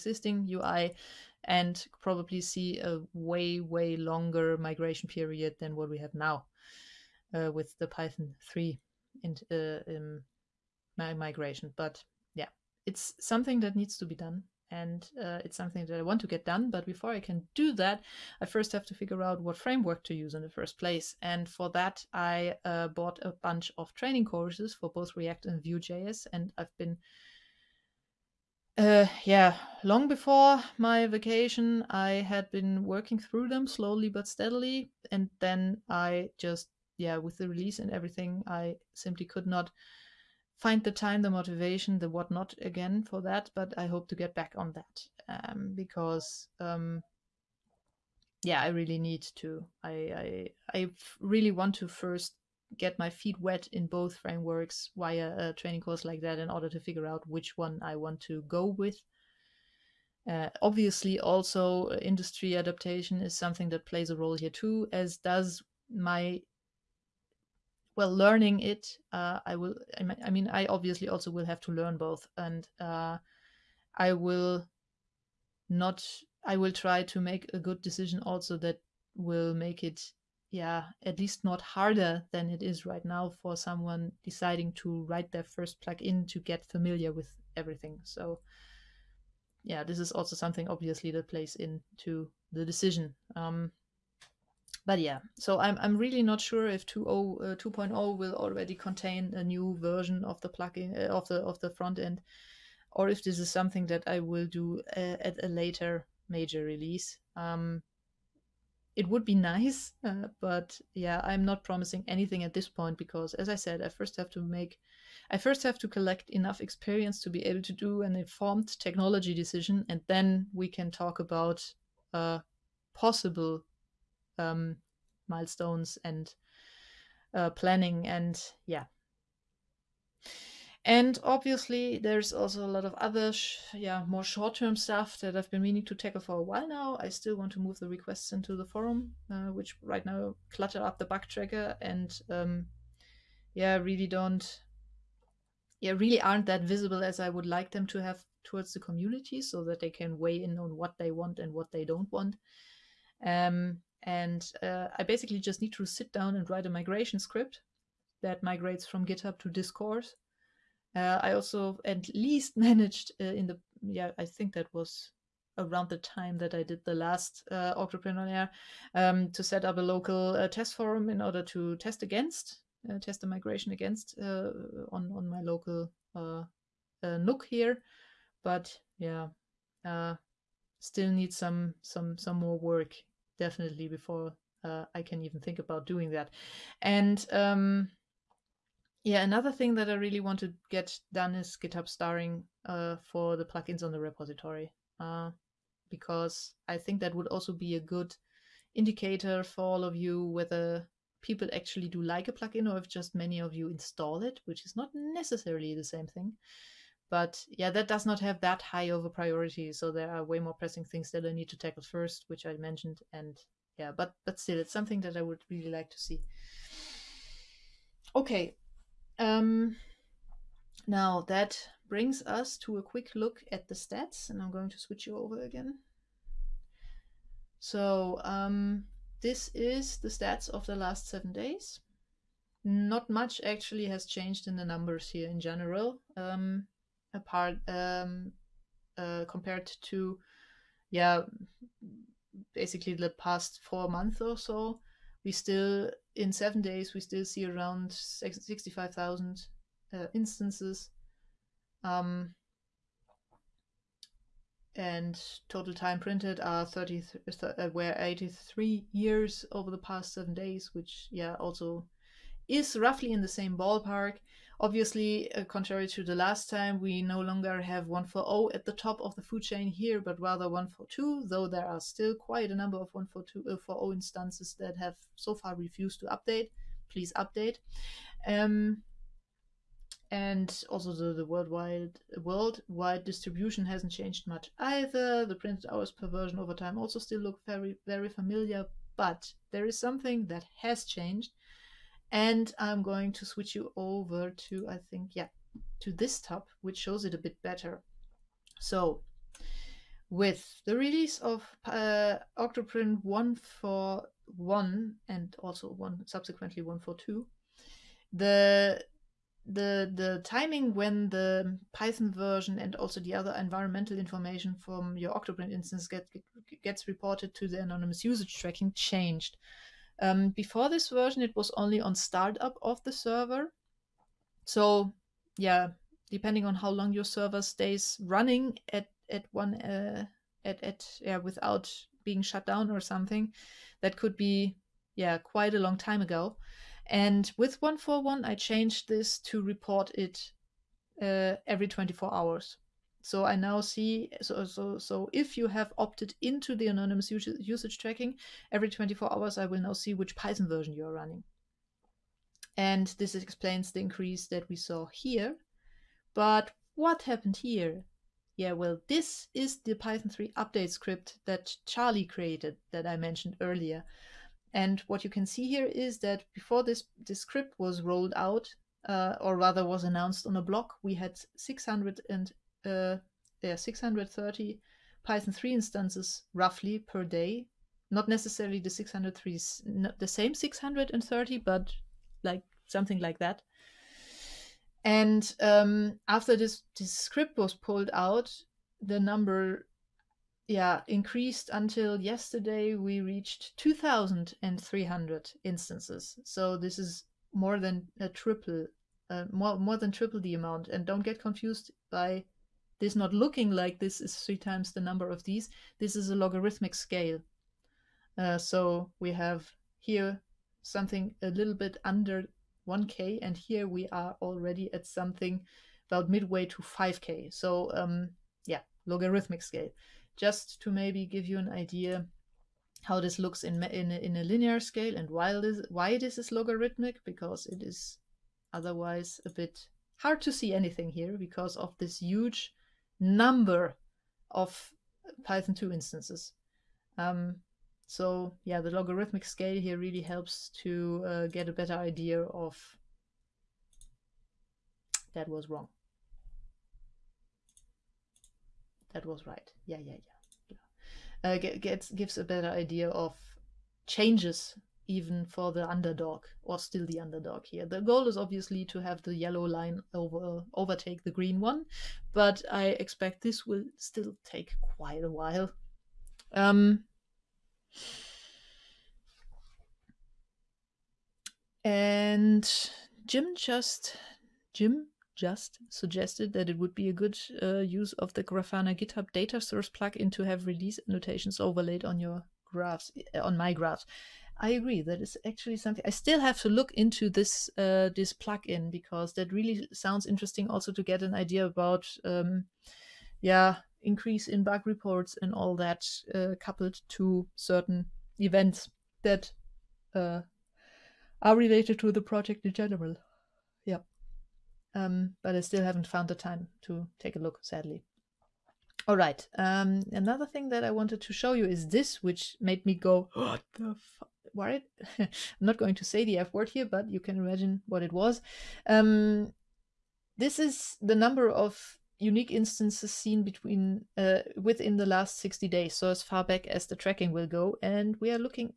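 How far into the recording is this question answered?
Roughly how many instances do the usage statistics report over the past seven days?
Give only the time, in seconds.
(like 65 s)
247 s.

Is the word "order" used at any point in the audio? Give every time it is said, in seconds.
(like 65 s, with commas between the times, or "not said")
56 s, 171 s.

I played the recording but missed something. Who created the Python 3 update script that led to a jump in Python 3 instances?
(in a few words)
Charlie.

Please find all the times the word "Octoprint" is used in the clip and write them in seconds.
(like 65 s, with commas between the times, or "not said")
302 s, 315 s.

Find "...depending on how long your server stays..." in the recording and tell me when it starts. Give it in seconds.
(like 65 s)
326 s.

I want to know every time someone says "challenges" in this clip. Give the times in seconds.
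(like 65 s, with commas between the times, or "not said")
not said.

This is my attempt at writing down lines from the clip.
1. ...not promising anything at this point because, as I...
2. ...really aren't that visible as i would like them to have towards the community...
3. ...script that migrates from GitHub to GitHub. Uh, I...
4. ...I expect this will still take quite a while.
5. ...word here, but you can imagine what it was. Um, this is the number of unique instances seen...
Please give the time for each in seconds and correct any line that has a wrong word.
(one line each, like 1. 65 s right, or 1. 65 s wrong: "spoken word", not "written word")
1. 111 s right
2. 145 s right
3. 157 s wrong: "Discourse", not "GitHub"
4. 462 s right
5. 516 s right.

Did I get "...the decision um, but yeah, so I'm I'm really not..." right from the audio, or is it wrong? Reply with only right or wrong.
right.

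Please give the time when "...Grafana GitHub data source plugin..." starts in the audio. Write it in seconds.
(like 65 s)
478 s.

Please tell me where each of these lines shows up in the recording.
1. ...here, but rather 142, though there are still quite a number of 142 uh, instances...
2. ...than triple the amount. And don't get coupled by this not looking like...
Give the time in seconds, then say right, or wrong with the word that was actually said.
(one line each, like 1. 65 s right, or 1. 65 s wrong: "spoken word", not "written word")
1. 269 s right
2. 399 s wrong: "confused", not "coupled".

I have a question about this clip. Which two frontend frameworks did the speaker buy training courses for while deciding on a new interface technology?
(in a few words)
React and Vue.js.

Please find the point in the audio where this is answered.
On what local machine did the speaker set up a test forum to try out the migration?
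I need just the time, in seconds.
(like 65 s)
177 s.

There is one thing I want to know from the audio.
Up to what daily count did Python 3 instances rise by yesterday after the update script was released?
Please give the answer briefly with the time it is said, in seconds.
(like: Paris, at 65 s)
2,300, at 393 s.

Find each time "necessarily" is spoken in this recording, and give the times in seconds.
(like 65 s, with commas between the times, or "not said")
204 s, 378 s.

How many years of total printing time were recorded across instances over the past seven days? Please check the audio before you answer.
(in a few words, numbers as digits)
83 years.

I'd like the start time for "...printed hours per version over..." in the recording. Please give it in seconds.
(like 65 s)
285 s.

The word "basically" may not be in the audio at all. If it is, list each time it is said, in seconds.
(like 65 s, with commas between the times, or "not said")
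155 s, 242 s.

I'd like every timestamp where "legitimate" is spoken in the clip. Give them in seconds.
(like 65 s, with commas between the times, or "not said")
not said.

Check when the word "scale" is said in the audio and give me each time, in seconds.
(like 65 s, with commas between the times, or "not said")
406 s, 419 s, 424 s, 439 s.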